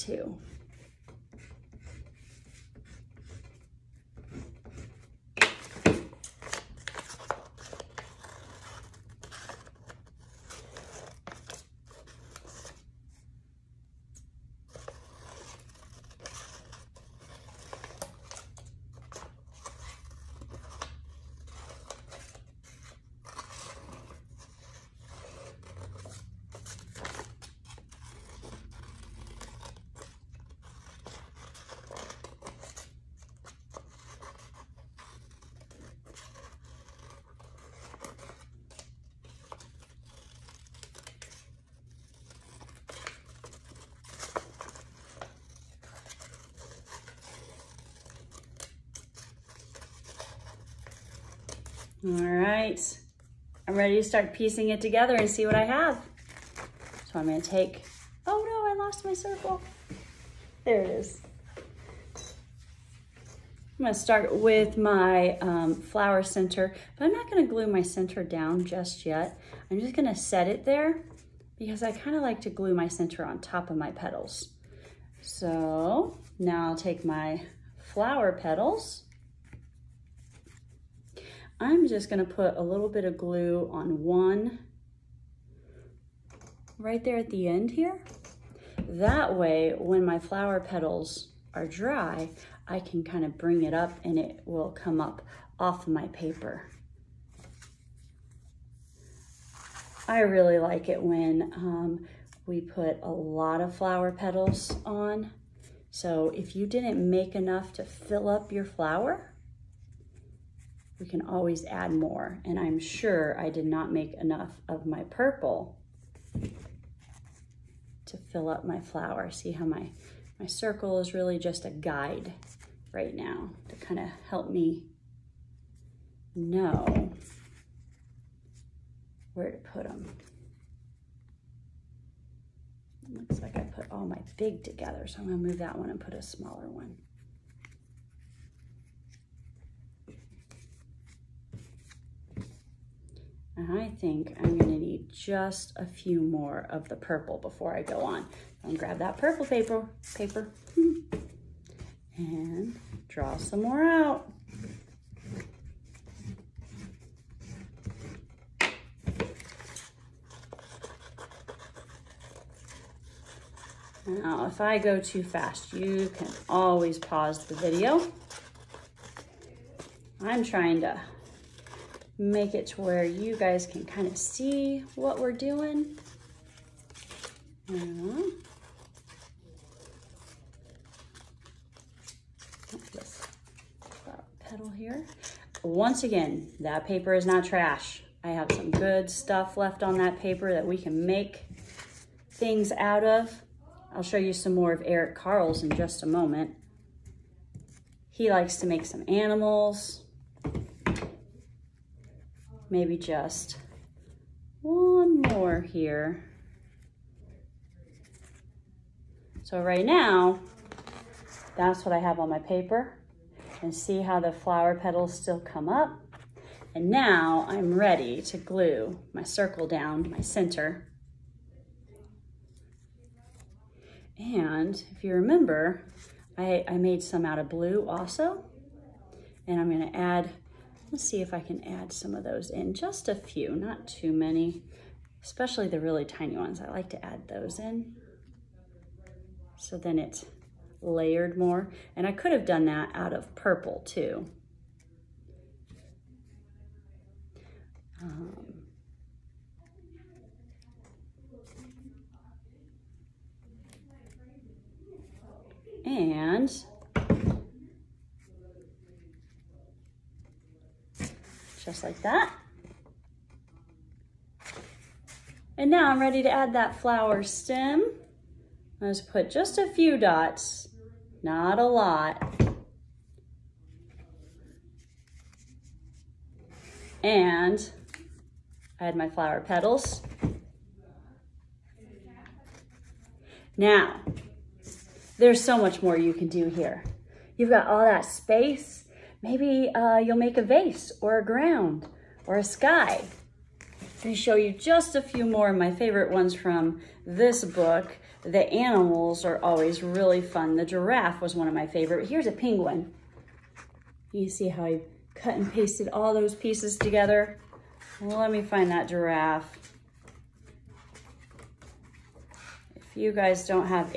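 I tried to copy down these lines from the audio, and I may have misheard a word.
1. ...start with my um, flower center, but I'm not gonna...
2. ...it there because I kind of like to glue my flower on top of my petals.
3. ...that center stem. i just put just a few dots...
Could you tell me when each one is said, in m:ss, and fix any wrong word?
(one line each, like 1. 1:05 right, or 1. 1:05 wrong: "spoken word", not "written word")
1. 1:03 right
2. 1:10 wrong: "center", not "flower"
3. 4:26 wrong: "flower", not "center".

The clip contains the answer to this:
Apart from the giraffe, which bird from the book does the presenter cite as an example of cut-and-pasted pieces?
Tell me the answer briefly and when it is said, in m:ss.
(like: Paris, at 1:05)
Penguin, at 5:02.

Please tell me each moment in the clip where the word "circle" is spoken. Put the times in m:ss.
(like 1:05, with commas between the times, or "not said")
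0:59, 2:00, 3:39.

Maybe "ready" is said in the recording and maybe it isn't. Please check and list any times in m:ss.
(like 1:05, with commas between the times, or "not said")
0:53, 3:37, 4:25.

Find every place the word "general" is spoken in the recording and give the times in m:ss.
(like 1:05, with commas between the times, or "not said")
not said.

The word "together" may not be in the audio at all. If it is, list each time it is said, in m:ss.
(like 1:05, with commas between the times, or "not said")
0:54, 2:14, 5:06.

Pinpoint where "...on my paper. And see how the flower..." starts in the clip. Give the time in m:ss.
3:32.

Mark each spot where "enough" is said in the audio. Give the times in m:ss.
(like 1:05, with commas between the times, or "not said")
1:47, 1:54.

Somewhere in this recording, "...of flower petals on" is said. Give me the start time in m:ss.
1:43.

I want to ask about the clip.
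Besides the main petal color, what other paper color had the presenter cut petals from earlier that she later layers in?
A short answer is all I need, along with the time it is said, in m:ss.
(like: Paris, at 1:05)
Blue, at 3:47.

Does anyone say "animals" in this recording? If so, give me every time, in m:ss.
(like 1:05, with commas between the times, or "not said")
3:19, 4:58.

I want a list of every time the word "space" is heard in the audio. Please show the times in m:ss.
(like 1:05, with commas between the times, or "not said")
4:48.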